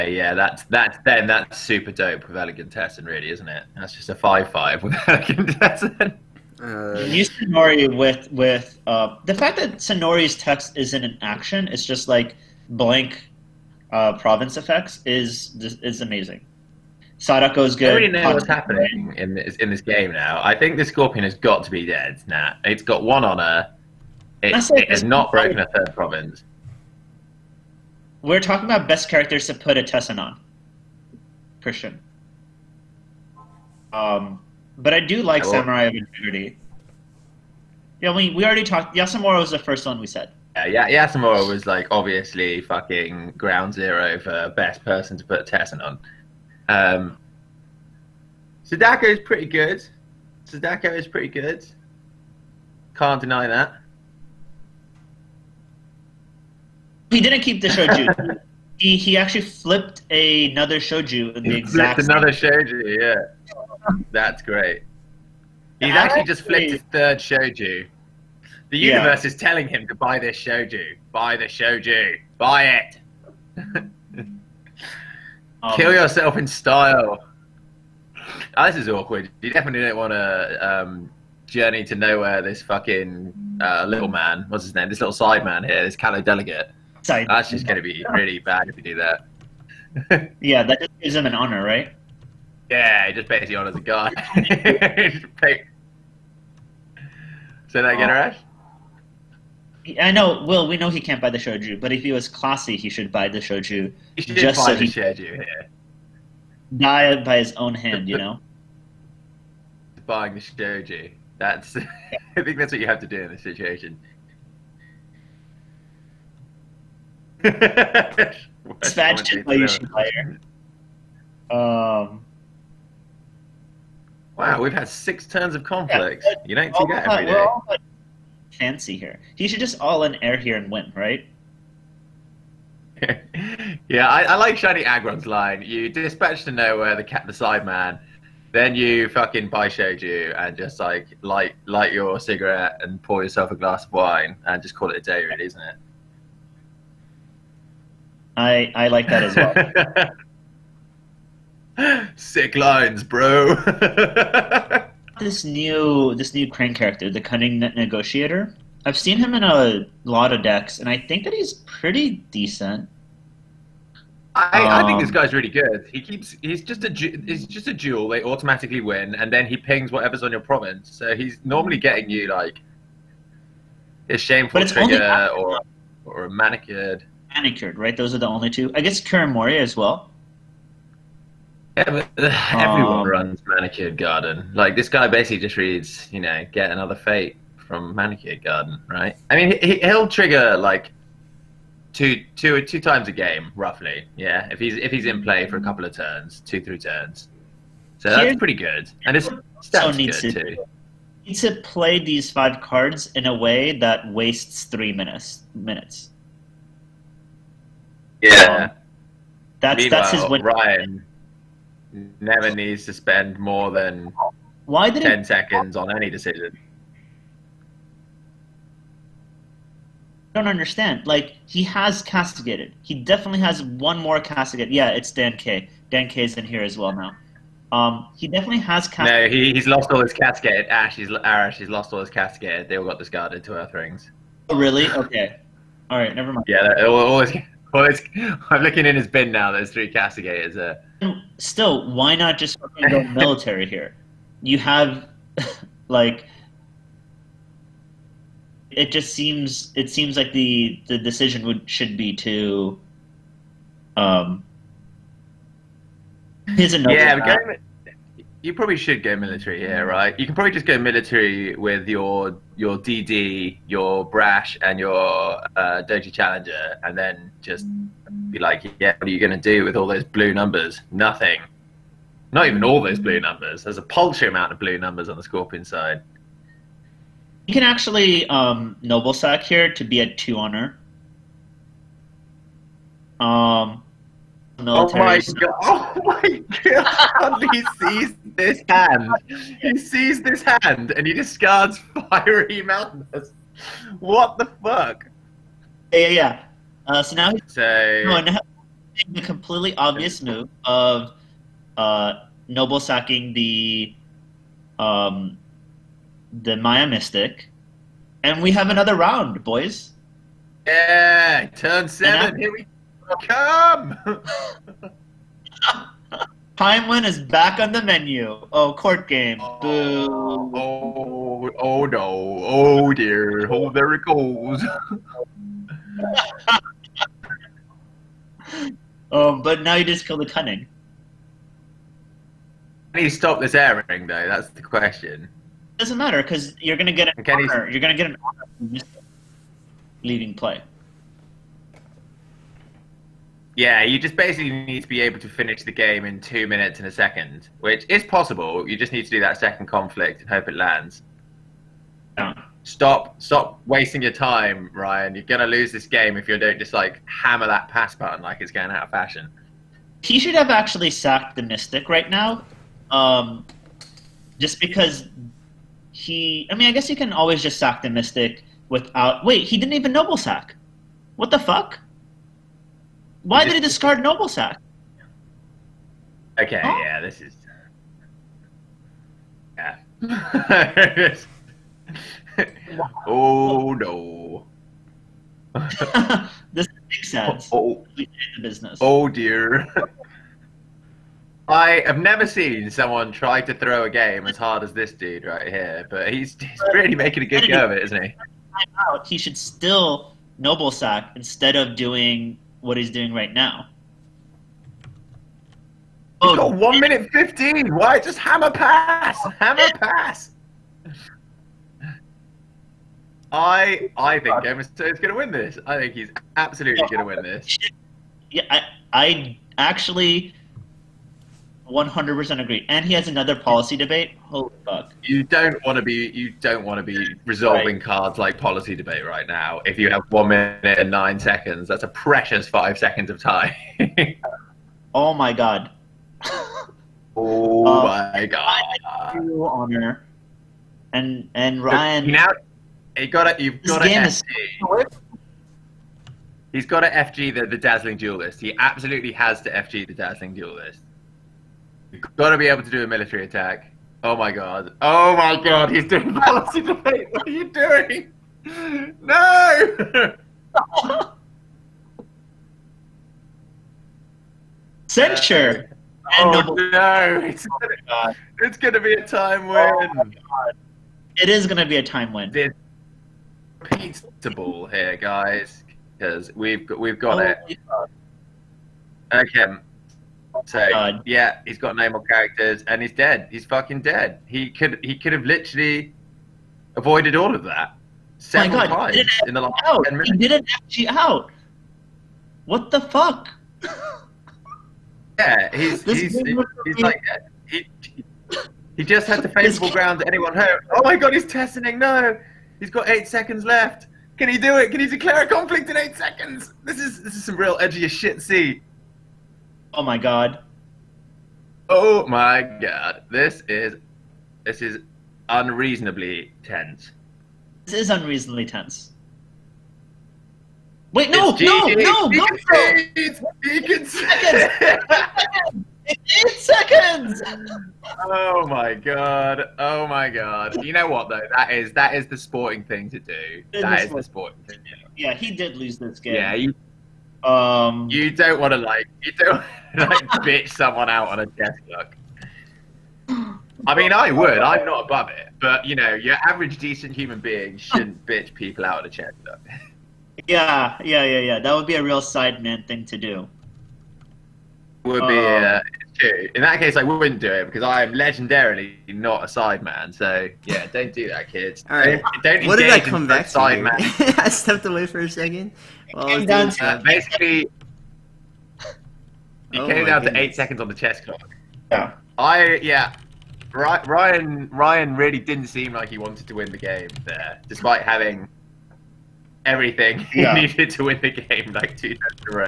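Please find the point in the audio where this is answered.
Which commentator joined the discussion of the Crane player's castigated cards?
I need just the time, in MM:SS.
03:45.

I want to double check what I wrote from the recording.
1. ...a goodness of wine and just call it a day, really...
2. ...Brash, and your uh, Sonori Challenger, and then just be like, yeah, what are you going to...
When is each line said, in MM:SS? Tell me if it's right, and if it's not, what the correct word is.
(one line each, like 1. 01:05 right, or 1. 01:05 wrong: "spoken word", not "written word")
1. 02:23 wrong: "glass", not "goodness"
2. 04:24 wrong: "Doji", not "Sonori".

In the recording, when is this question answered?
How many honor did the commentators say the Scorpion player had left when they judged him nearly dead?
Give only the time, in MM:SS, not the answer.
00:22.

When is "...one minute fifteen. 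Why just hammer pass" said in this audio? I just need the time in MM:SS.
06:46.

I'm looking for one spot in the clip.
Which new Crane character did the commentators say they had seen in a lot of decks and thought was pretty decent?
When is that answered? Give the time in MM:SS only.
02:37.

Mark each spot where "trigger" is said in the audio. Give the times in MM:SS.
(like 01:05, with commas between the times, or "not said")
02:54, 03:10.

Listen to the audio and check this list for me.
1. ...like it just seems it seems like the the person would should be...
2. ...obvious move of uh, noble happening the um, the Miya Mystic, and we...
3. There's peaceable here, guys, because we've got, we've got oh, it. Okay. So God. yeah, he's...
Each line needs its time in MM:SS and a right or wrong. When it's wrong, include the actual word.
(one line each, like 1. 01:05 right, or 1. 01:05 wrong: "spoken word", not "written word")
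1. 04:05 wrong: "decision", not "person"
2. 04:59 wrong: "sacking", not "happening"
3. 07:52 right.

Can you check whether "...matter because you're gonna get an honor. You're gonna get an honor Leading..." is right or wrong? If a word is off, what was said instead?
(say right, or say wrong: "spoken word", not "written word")
right.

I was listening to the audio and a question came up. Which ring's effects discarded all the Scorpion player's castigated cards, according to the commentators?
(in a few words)
Earth.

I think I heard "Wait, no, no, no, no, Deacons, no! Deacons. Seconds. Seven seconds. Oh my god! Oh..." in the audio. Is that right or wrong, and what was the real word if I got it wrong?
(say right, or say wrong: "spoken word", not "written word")
wrong: "Eight", not "Seven".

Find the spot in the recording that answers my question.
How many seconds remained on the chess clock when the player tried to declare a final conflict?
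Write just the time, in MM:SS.
08:22.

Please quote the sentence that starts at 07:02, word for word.
And he has another policy debate.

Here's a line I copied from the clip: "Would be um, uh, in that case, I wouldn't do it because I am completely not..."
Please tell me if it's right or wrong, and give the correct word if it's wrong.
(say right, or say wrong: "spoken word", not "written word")
wrong: "legendarily", not "completely".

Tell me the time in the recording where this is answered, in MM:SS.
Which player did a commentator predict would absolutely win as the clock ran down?
06:53.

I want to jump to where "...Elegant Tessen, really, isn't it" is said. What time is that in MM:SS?
00:02.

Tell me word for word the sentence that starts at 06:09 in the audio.
Wait, he didn't even noble sack.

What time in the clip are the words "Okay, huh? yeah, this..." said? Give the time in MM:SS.
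06:16.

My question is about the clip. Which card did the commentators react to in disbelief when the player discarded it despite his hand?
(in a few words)
Fiery Mountains.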